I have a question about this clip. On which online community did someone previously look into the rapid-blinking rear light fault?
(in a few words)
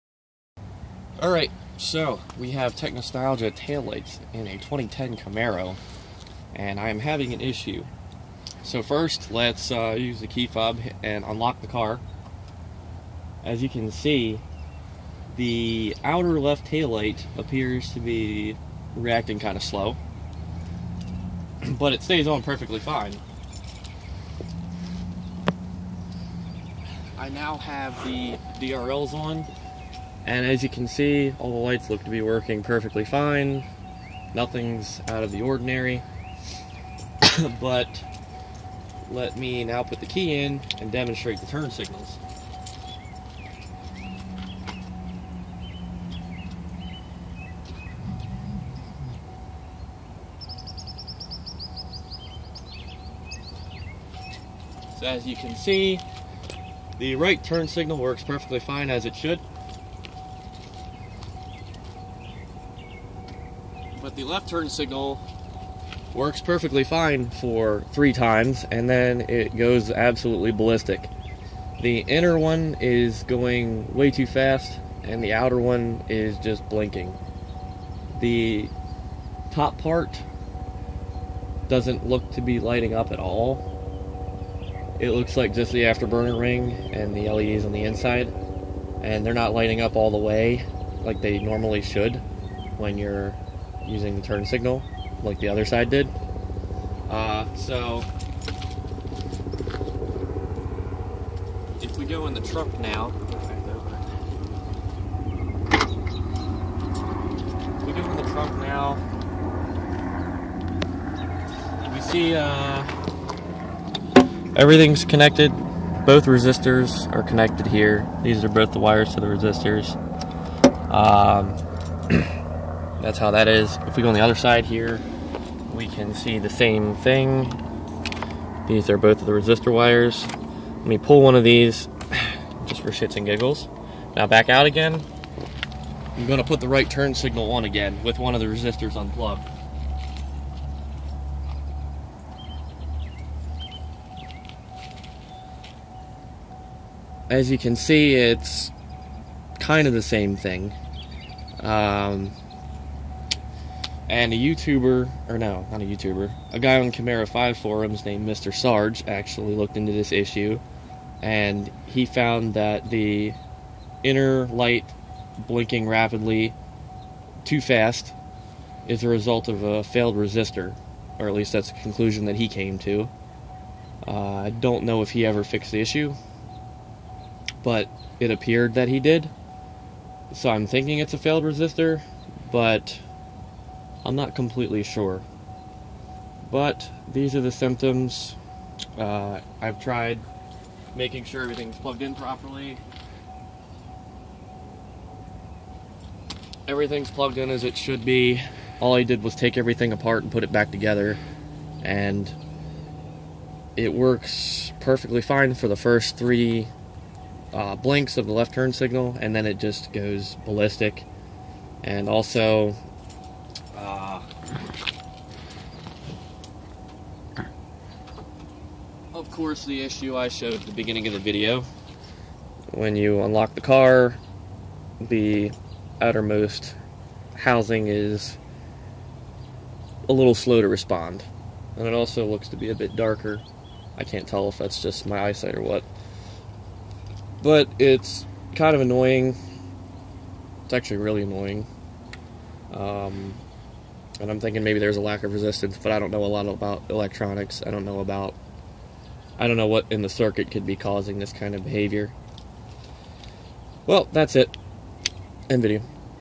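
Camaro5 forums.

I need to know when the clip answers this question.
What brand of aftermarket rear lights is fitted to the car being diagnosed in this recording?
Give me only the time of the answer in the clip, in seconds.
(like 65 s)
2 s.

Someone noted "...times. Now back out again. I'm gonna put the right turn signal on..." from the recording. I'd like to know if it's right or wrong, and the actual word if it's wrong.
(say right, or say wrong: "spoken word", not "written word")
wrong: "giggles", not "times".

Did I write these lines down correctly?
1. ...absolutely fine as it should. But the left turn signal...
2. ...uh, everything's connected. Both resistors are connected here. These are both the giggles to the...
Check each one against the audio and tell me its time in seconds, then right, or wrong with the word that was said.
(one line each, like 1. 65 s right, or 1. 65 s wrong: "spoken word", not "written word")
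1. 58 s wrong: "perfectly", not "absolutely"
2. 112 s wrong: "wires", not "giggles".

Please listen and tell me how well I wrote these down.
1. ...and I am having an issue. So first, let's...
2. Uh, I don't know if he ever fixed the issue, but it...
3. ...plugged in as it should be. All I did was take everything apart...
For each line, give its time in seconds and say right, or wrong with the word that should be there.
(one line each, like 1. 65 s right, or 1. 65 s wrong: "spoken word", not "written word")
1. 6 s right
2. 174 s right
3. 197 s right.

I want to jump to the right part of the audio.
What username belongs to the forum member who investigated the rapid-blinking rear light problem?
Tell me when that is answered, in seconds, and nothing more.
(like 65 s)
158 s.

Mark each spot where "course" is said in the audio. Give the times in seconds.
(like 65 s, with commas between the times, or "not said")
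219 s.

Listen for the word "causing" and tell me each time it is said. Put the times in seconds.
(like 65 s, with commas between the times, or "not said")
250 s.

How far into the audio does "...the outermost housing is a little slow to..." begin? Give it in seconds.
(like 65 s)
224 s.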